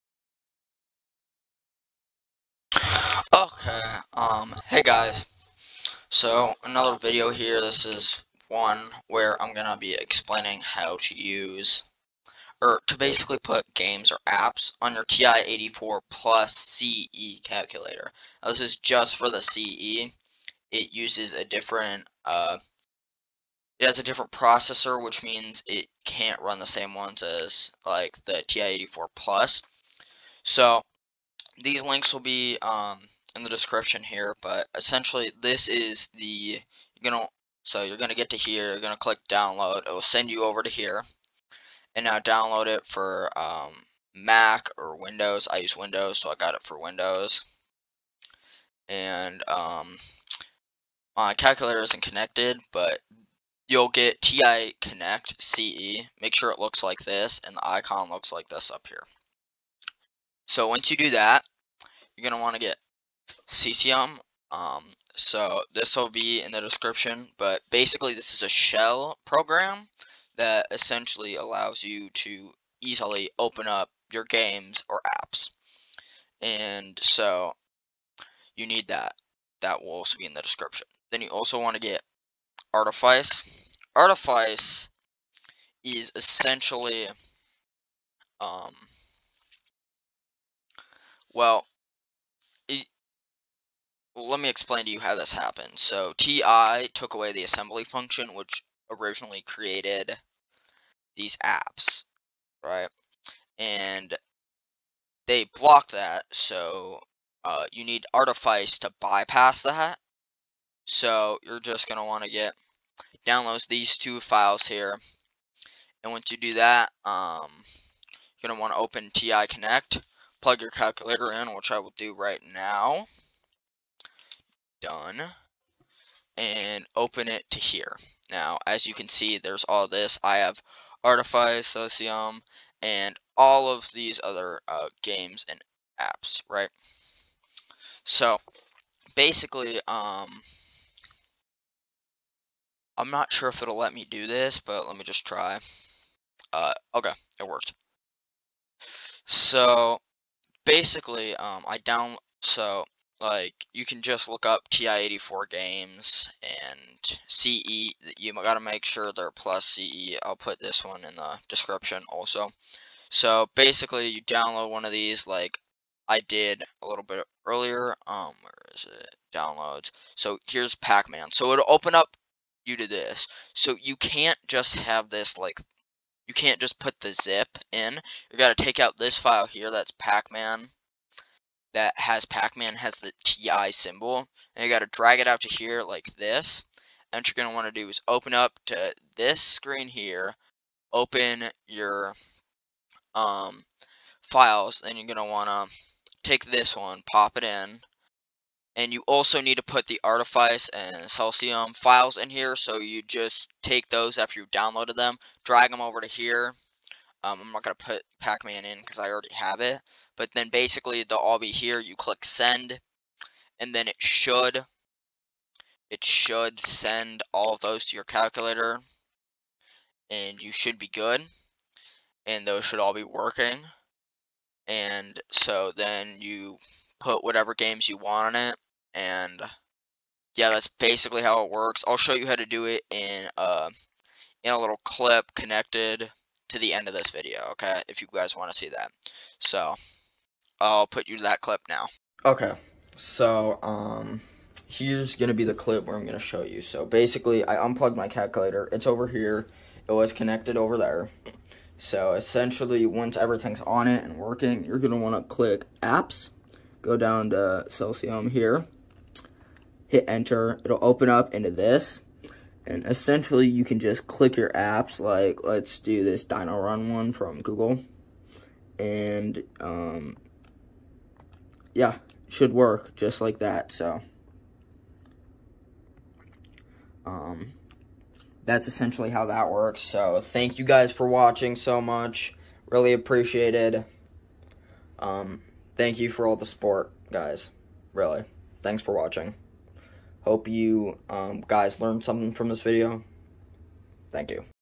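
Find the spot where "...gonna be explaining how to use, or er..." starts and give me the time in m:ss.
0:09.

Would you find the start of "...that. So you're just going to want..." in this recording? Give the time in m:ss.
1:49.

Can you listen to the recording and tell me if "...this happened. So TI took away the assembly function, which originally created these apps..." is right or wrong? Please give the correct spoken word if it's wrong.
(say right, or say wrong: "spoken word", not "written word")
right.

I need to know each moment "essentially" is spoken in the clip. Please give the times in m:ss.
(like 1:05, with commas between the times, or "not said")
0:34, 1:10, 1:26, 4:12, 4:22, 4:38.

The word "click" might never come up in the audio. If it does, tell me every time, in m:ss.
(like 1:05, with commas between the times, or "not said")
0:38, 3:31, 4:15, 4:24.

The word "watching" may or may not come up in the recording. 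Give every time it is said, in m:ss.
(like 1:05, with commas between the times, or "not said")
4:41, 4:48.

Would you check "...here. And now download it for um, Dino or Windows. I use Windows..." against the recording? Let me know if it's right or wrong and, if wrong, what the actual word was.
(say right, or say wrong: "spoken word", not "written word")
wrong: "Mac", not "Dino".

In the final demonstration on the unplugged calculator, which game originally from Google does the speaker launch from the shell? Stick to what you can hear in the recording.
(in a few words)
Dino Run.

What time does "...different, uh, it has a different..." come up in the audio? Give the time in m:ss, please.
0:21.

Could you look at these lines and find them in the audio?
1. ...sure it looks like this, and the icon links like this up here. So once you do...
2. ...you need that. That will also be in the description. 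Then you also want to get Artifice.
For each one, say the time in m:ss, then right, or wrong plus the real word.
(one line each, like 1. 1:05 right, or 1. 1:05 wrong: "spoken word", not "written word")
1. 0:56 wrong: "looks", not "links"
2. 1:18 right.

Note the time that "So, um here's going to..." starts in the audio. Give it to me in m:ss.
4:02.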